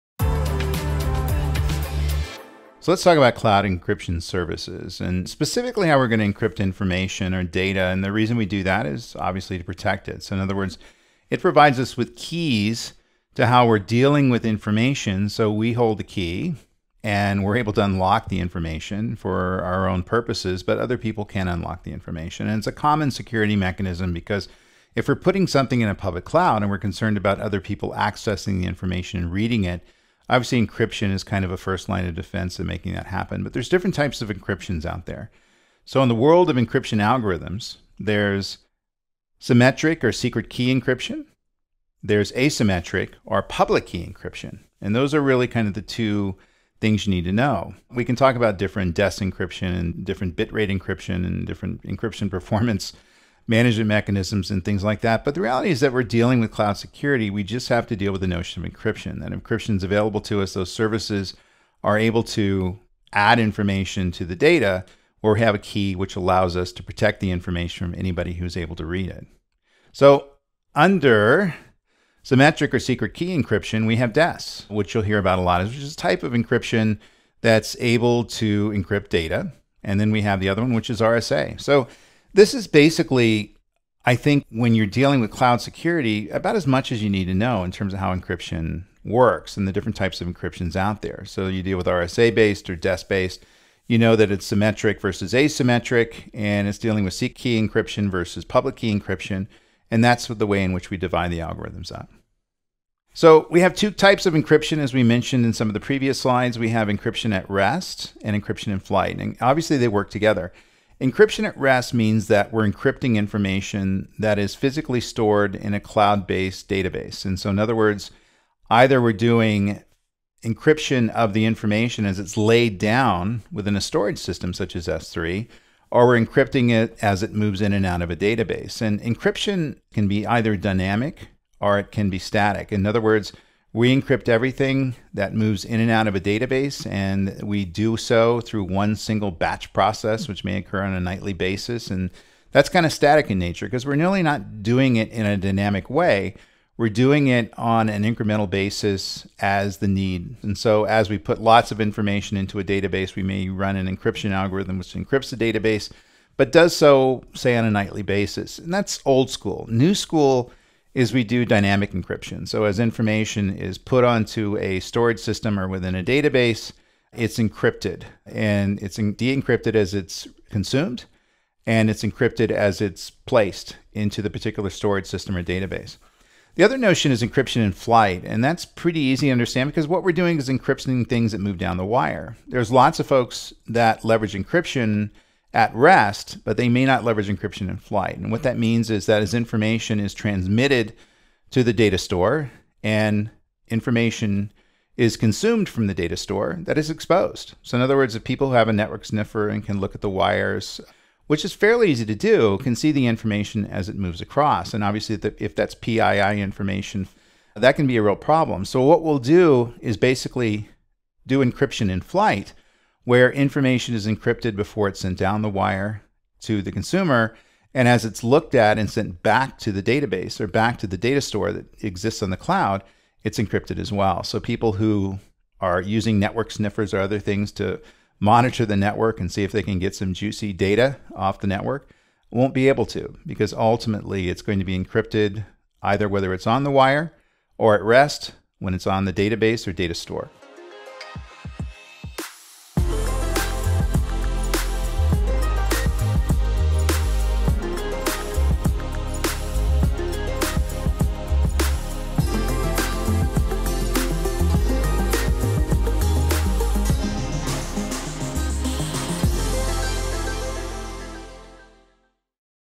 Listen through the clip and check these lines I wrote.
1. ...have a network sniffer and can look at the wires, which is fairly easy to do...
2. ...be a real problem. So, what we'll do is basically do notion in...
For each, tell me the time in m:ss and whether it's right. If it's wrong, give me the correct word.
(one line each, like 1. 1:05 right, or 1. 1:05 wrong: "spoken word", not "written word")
1. 3:18 right
2. 3:27 wrong: "encryption", not "notion".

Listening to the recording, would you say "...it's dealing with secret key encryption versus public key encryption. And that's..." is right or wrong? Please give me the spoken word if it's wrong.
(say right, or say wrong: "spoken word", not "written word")
right.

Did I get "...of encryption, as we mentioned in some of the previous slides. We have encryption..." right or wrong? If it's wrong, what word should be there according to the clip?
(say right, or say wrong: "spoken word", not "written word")
right.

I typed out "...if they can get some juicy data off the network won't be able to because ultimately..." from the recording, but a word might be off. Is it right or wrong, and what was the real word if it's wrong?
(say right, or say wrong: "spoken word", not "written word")
right.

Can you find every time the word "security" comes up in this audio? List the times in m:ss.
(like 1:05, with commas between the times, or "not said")
0:23, 0:56, 1:25.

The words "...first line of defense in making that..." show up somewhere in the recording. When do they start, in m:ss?
0:31.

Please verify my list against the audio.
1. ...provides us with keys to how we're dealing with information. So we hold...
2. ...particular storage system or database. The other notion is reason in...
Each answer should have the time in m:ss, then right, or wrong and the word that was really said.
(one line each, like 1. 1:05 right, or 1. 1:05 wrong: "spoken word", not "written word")
1. 0:11 right
2. 2:54 wrong: "encryption", not "reason".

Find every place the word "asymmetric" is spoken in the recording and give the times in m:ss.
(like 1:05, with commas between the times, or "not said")
0:42, 1:35.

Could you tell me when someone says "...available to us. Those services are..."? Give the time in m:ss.
0:59.